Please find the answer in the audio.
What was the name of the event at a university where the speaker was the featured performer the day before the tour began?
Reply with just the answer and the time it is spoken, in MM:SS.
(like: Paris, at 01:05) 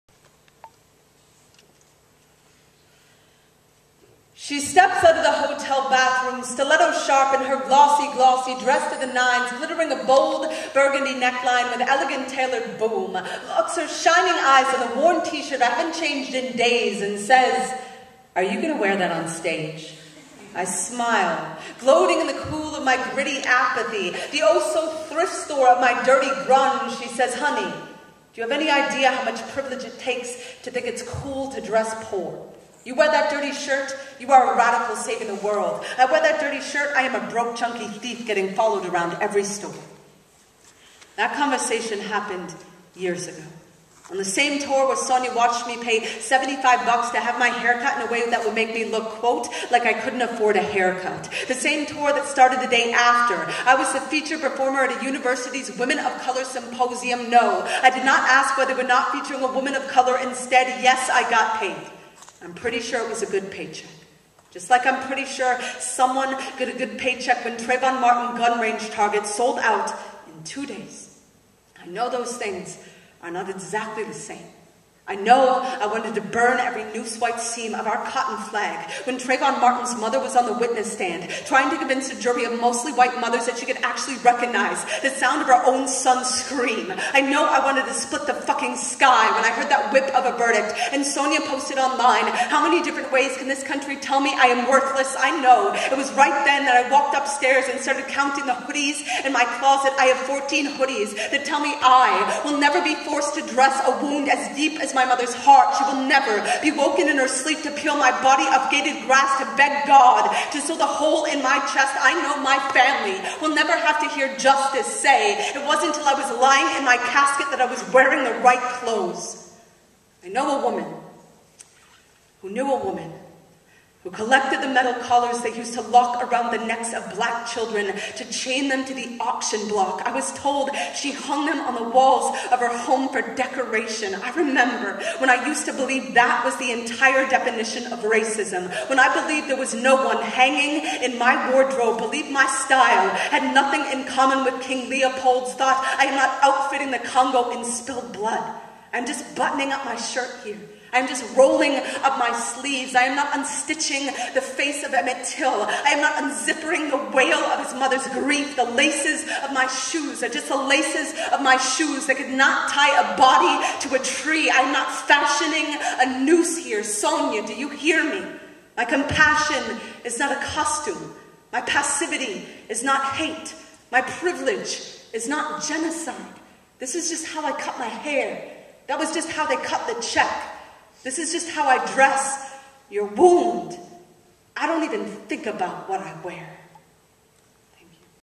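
Women of Color symposium, at 00:55.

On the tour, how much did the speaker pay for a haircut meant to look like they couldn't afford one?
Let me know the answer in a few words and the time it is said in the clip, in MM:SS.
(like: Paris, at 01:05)
$75, at 00:46.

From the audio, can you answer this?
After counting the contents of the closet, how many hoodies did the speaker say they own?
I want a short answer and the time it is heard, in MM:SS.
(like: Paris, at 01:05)
14, at 01:40.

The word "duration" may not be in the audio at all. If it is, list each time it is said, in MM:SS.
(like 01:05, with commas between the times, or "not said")
not said.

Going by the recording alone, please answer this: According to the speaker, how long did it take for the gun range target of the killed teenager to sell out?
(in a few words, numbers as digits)
2 days.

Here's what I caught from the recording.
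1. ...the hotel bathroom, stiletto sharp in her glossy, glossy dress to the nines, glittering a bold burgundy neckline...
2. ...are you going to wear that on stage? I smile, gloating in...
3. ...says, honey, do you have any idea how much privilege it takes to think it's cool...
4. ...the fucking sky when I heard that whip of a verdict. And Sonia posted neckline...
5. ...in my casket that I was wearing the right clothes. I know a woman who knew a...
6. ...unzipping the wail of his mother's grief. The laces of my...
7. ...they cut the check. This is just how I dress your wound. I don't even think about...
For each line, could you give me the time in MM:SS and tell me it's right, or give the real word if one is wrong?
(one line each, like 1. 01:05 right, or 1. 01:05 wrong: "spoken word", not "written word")
1. 00:05 right
2. 00:18 right
3. 00:27 right
4. 01:28 wrong: "online", not "neckline"
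5. 01:56 right
6. 02:36 right
7. 02:59 right.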